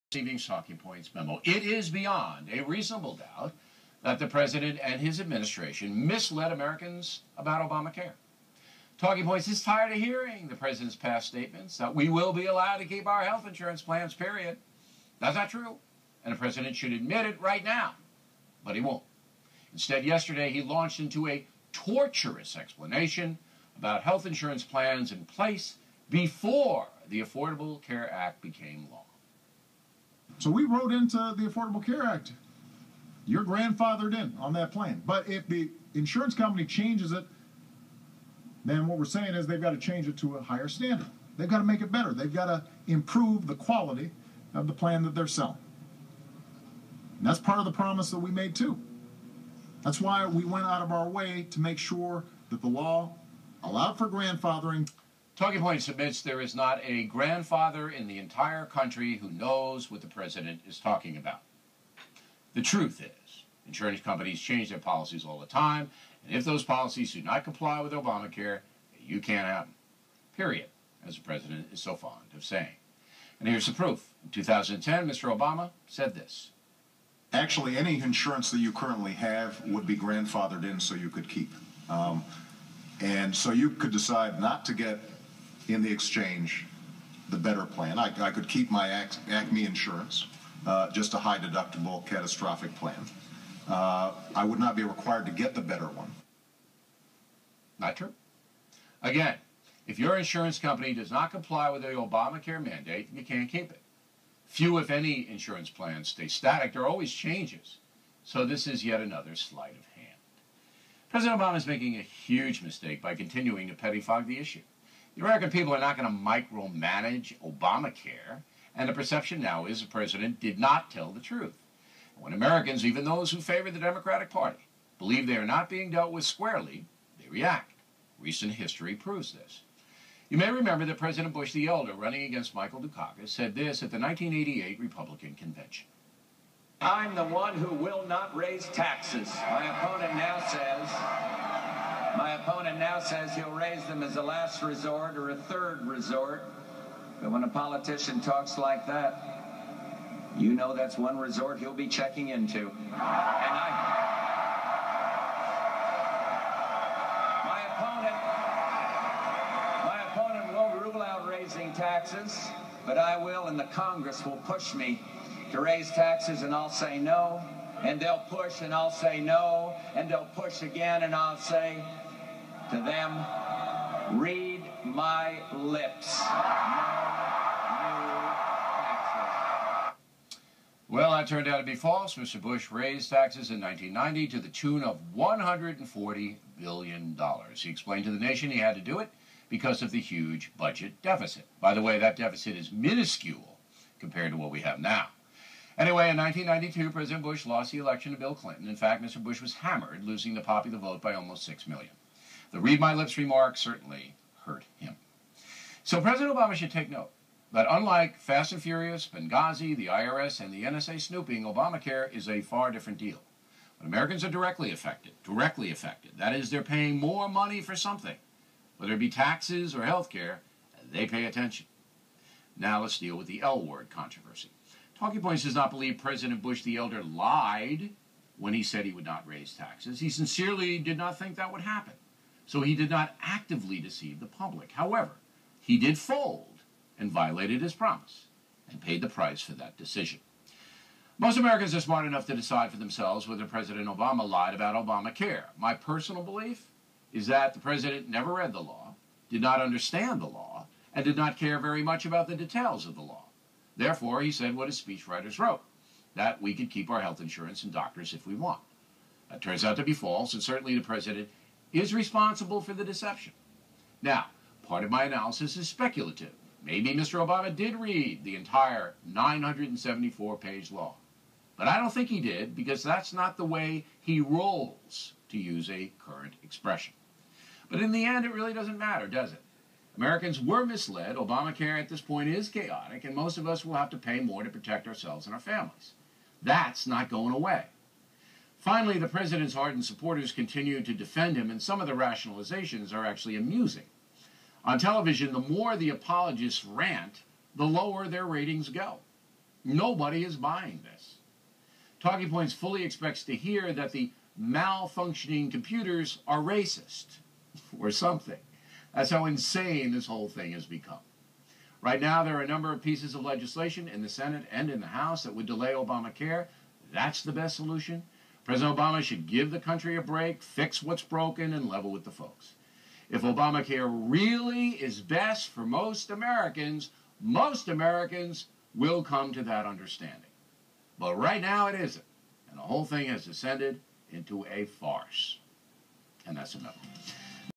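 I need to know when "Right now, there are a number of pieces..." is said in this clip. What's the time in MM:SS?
05:11.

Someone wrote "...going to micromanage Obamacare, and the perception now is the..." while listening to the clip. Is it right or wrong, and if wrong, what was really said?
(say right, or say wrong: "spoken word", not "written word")
right.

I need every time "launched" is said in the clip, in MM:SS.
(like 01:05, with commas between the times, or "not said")
00:20.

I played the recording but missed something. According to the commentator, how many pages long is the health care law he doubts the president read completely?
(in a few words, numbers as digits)
974.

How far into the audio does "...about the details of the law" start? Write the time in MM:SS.
04:12.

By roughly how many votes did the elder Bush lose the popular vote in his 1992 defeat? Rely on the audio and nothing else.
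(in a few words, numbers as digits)
almost 6 million.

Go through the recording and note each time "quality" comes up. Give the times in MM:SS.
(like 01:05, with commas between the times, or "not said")
00:43.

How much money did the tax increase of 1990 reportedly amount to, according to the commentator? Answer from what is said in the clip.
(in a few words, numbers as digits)
$140 billion.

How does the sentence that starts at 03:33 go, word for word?
But Americans are directly affected, directly affected.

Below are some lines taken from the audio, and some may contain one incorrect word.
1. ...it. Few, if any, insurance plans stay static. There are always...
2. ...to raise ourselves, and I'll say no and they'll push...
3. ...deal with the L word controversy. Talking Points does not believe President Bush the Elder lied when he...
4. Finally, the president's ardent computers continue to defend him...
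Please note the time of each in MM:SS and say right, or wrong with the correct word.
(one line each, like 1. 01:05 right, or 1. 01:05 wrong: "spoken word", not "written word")
1. 01:43 right
2. 02:45 wrong: "taxes", not "ourselves"
3. 03:42 right
4. 04:48 wrong: "supporters", not "computers".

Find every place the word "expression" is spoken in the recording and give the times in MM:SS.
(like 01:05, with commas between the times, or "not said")
04:36.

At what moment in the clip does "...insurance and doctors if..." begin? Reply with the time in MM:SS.
04:17.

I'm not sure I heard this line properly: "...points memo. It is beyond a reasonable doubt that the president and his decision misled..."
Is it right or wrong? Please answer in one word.
wrong.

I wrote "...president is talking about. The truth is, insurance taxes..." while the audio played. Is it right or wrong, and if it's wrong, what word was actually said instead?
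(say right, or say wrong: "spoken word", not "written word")
wrong: "companies", not "taxes".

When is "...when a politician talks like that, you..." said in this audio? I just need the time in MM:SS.
02:27.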